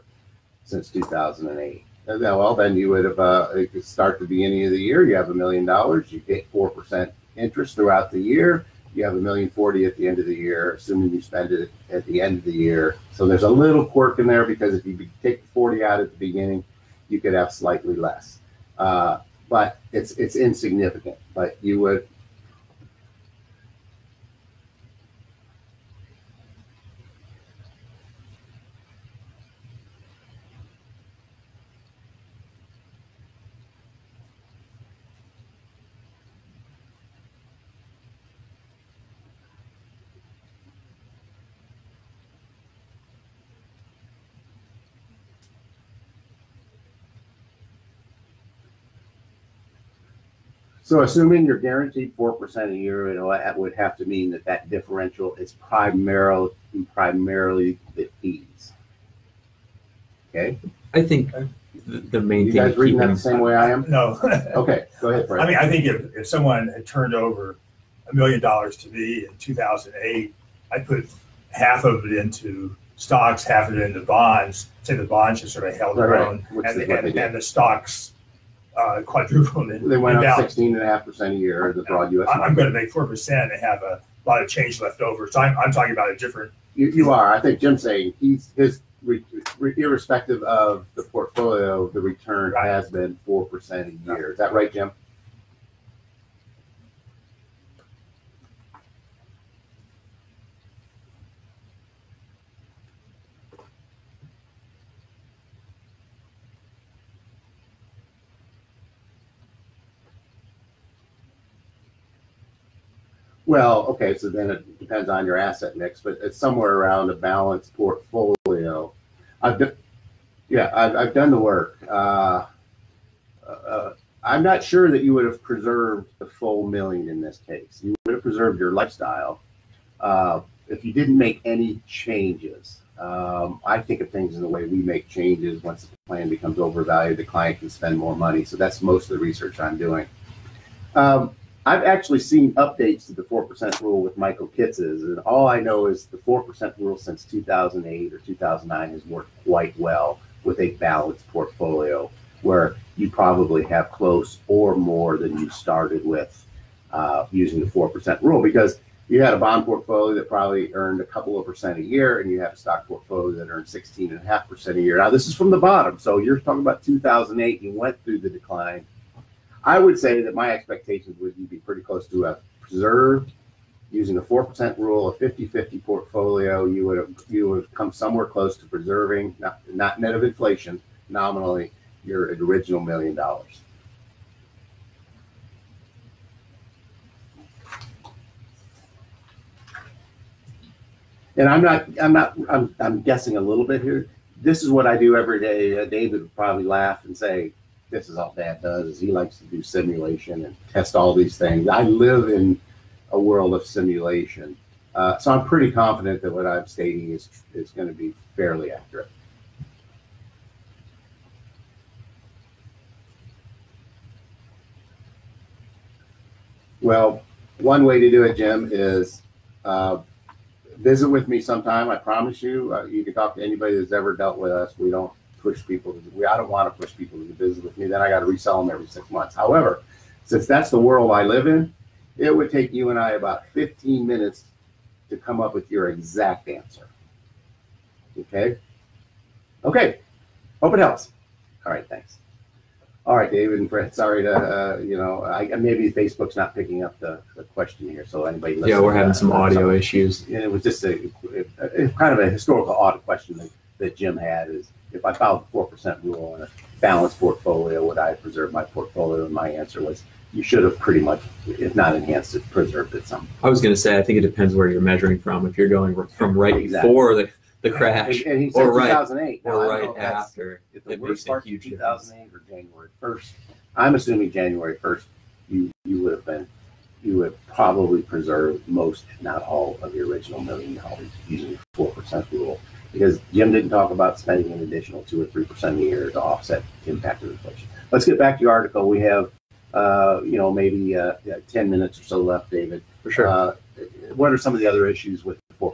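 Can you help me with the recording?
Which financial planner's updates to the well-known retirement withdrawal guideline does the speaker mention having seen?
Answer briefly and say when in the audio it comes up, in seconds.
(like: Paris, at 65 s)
Michael Kitces, at 144 s.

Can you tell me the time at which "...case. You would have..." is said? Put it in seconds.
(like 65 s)
127 s.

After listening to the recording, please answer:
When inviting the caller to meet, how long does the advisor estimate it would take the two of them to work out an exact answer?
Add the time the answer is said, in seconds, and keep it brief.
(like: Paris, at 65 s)
15 minutes, at 233 s.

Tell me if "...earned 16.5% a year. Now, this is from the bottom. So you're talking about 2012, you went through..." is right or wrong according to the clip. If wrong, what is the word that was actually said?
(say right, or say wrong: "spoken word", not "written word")
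wrong: "2008", not "2012".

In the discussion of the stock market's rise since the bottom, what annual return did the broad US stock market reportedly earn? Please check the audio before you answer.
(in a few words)
16.5% a year.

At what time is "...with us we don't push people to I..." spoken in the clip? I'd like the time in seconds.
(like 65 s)
224 s.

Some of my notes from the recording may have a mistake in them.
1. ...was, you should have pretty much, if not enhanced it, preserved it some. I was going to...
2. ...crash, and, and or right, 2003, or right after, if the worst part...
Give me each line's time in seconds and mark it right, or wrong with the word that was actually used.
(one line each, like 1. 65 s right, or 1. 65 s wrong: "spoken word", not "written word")
1. 259 s right
2. 267 s wrong: "2008", not "2003".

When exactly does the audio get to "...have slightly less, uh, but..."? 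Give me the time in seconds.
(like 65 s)
17 s.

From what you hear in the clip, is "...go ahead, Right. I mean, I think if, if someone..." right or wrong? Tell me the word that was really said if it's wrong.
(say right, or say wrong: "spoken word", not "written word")
wrong: "Brad", not "Right".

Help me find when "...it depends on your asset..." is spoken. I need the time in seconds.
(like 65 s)
114 s.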